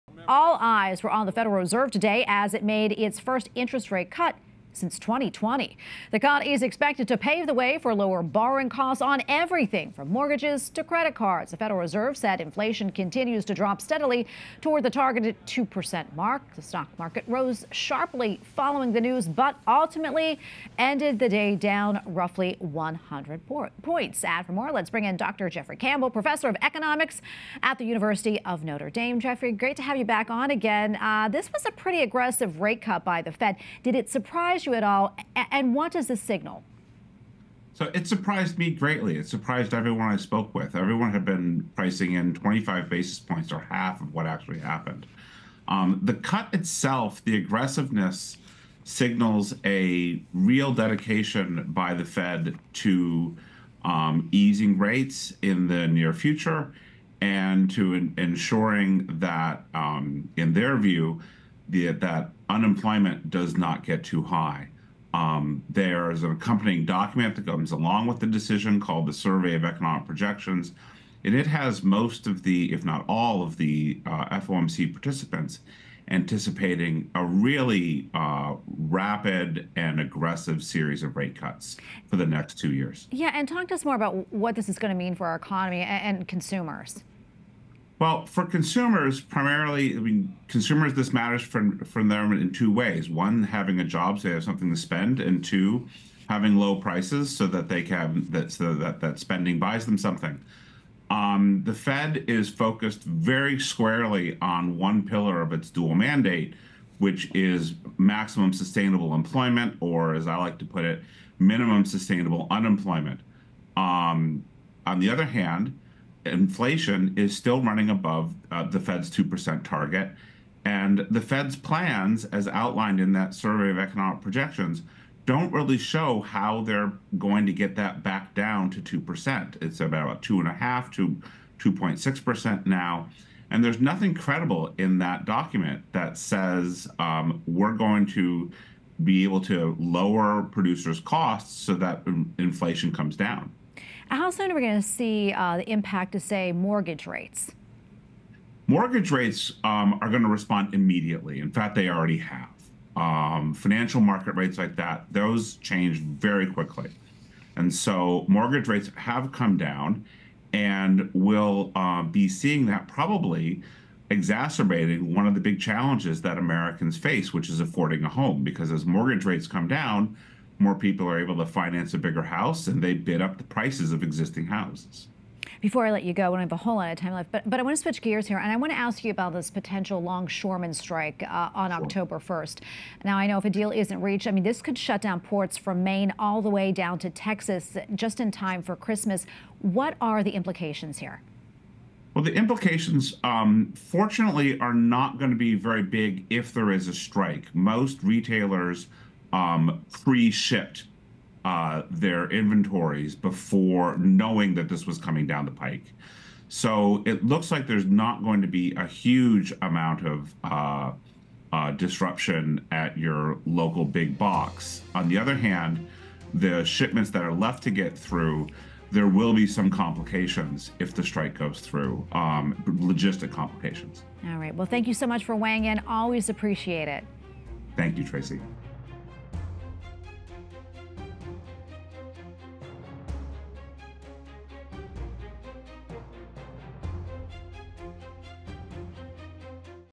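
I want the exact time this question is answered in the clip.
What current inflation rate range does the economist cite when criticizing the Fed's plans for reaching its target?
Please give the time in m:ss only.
2:10.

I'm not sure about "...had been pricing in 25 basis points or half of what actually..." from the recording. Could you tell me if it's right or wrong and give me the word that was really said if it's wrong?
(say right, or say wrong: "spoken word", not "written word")
right.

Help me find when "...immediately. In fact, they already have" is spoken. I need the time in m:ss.
2:30.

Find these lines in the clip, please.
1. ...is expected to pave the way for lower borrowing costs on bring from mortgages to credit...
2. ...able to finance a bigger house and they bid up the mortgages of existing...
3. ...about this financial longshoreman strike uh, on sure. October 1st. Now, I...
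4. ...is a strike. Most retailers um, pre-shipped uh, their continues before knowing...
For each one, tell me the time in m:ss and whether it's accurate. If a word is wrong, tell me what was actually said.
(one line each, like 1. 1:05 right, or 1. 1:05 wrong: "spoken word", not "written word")
1. 0:06 wrong: "everything", not "bring"
2. 2:51 wrong: "prices", not "mortgages"
3. 2:59 wrong: "potential", not "financial"
4. 3:16 wrong: "inventories", not "continues".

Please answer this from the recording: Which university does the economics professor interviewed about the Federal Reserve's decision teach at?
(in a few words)
University of Notre Dame.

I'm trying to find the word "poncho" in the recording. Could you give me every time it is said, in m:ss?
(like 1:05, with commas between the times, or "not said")
not said.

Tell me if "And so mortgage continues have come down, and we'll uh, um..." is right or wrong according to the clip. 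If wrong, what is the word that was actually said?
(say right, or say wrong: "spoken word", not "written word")
wrong: "rates", not "continues".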